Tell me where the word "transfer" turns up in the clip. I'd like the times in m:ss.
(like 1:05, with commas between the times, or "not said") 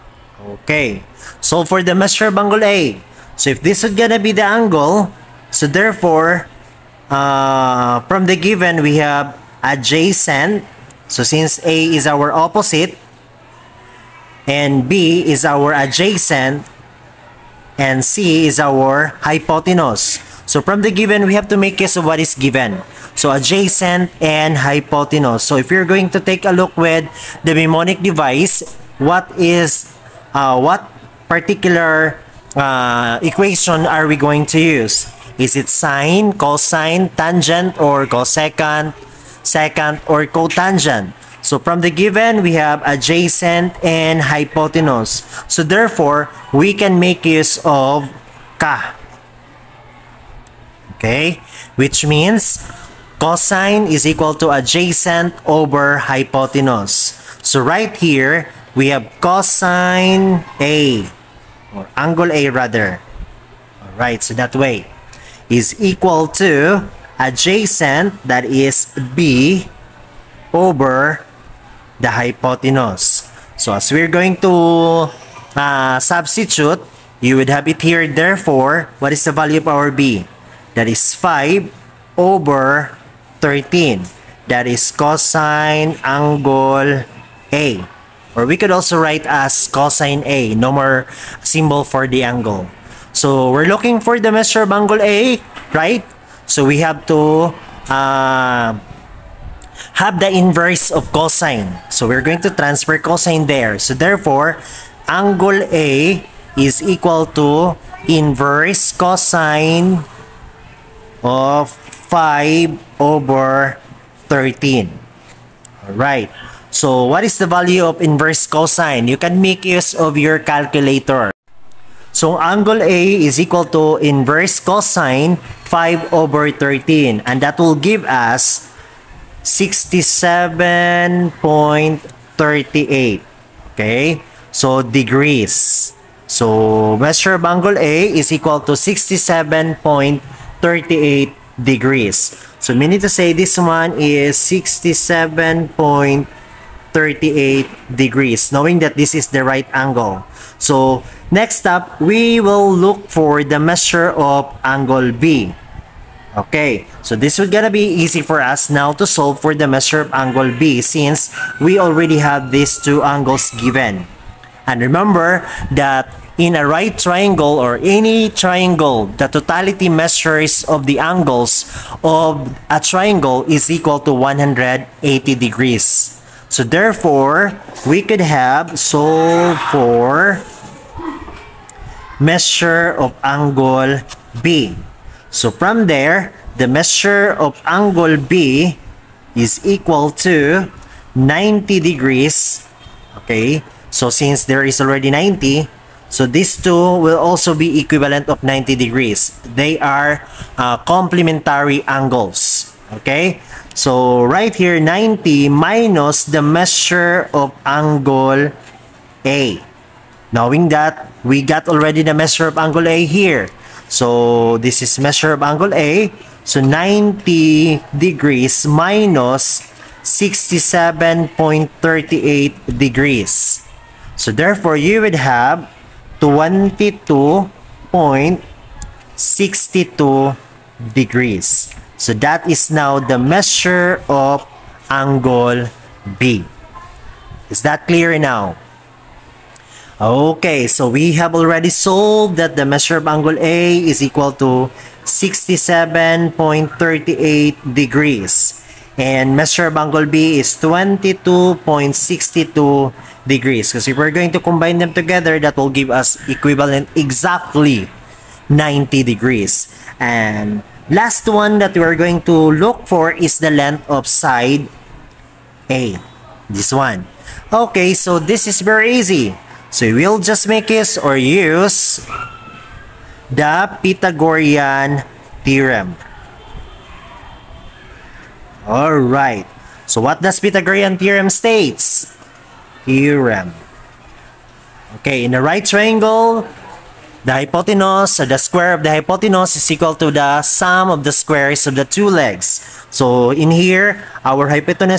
1:42.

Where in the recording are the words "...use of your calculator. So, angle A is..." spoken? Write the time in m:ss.
1:59.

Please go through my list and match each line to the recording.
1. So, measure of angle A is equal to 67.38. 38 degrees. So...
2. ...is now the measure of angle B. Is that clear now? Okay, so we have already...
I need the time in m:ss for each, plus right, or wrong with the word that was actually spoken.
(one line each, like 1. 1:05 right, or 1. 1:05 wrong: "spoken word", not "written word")
1. 2:16 right
2. 3:52 right.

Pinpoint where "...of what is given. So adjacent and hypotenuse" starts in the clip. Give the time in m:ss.
0:22.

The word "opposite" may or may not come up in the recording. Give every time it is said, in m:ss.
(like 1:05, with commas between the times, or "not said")
0:12.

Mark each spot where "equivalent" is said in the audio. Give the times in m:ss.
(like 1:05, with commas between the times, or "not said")
3:17, 4:16.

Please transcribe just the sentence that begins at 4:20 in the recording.
And last one that we're going to look for is the length of side A.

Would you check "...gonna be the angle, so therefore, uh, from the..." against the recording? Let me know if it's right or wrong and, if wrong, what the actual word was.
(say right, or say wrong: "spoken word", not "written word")
right.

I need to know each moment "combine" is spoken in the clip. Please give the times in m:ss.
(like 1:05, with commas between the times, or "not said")
4:14.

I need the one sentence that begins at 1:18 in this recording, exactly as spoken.
Therefore, what is the value of our B?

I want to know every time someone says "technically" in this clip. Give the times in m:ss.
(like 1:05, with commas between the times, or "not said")
not said.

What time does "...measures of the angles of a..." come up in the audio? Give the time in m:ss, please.
2:49.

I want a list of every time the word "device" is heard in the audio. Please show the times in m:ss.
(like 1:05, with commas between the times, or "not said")
0:28.